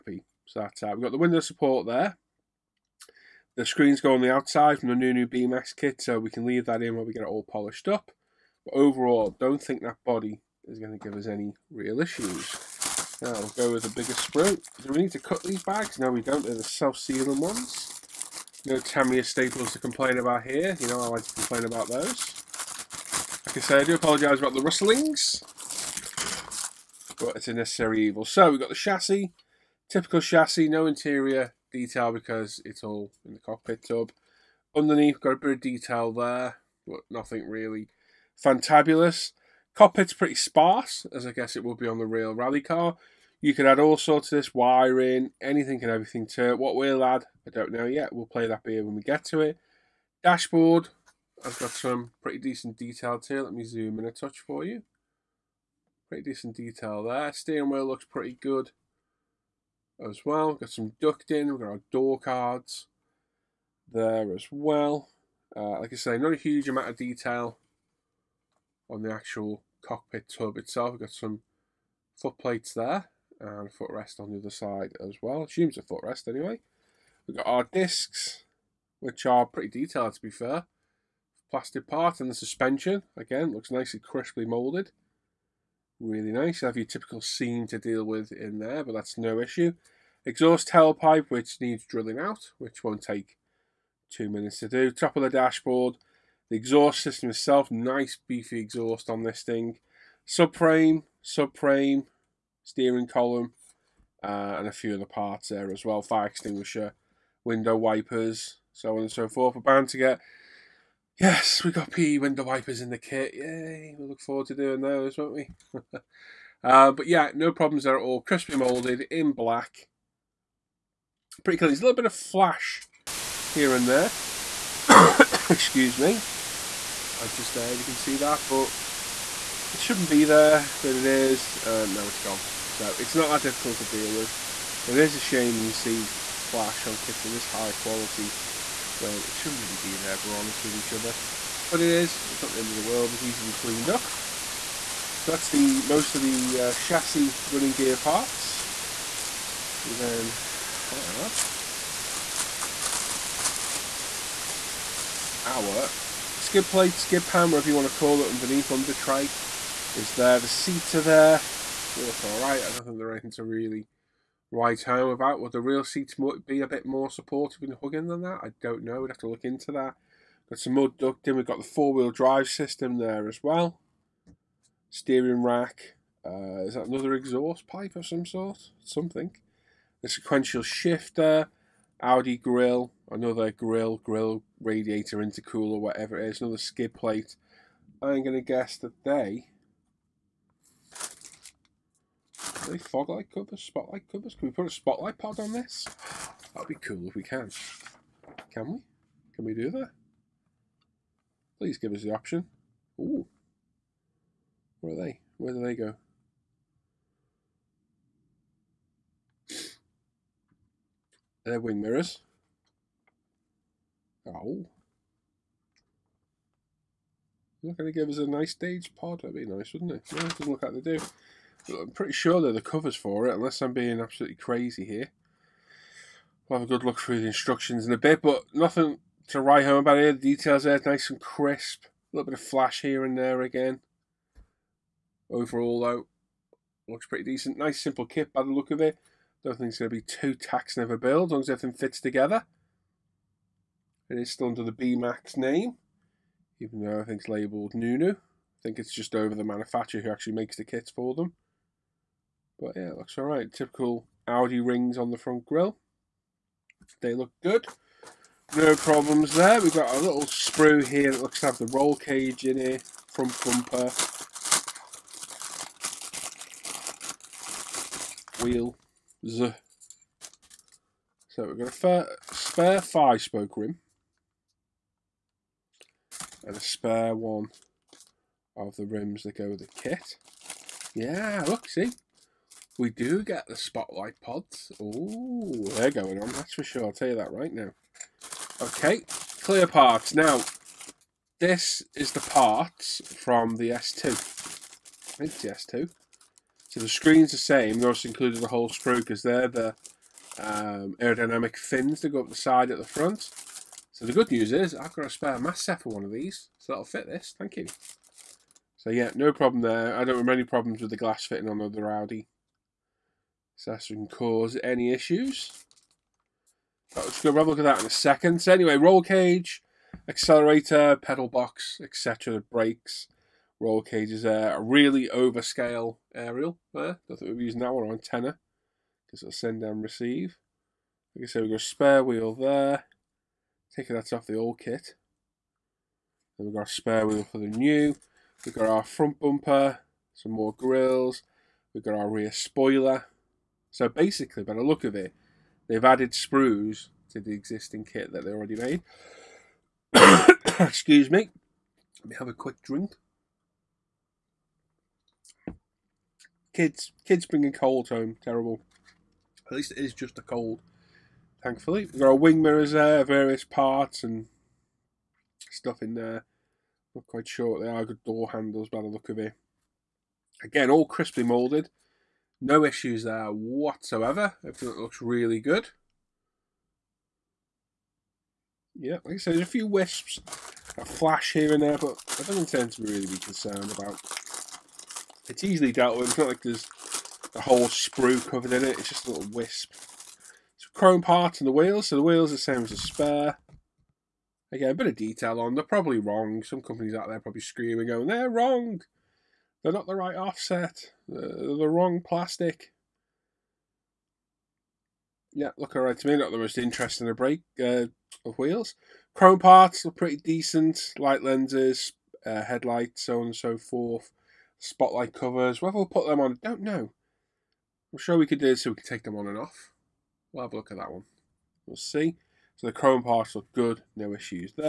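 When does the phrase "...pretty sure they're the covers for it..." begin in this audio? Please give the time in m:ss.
3:41.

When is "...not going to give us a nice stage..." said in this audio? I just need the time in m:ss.
3:37.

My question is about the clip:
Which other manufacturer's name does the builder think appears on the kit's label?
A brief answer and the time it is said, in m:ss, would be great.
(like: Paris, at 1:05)
Nunu, at 4:07.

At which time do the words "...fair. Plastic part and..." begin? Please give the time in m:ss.
1:20.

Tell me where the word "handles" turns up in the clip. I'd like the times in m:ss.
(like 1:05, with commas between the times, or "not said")
6:08.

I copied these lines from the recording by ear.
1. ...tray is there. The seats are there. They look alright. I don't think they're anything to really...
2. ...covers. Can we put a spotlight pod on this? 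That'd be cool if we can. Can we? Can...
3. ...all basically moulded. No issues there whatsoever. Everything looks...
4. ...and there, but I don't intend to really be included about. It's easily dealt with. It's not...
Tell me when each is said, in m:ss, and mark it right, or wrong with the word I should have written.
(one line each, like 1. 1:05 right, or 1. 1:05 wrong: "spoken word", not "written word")
1. 2:38 right
2. 3:14 right
3. 6:10 wrong: "crisply", not "basically"
4. 6:21 wrong: "concerned", not "included".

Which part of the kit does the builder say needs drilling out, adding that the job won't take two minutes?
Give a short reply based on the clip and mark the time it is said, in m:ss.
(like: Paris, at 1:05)
exhaust tailpipe, at 1:30.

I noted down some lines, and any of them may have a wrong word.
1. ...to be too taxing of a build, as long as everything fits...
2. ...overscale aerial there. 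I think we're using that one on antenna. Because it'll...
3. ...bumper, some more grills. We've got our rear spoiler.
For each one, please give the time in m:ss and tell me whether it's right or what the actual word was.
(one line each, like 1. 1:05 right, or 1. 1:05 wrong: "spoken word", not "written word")
1. 3:59 right
2. 5:25 right
3. 5:39 right.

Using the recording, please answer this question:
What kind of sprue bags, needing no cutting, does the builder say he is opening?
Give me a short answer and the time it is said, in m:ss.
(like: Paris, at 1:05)
self-sealing, at 0:16.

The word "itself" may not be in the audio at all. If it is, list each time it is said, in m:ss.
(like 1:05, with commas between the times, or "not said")
1:10, 1:37.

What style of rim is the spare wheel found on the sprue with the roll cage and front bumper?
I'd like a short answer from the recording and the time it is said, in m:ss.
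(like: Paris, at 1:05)
five spoke, at 4:32.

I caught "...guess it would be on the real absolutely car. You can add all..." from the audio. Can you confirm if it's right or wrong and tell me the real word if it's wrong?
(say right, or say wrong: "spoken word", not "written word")
wrong: "rally", not "absolutely".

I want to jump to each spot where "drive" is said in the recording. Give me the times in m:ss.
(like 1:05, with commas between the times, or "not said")
2:52.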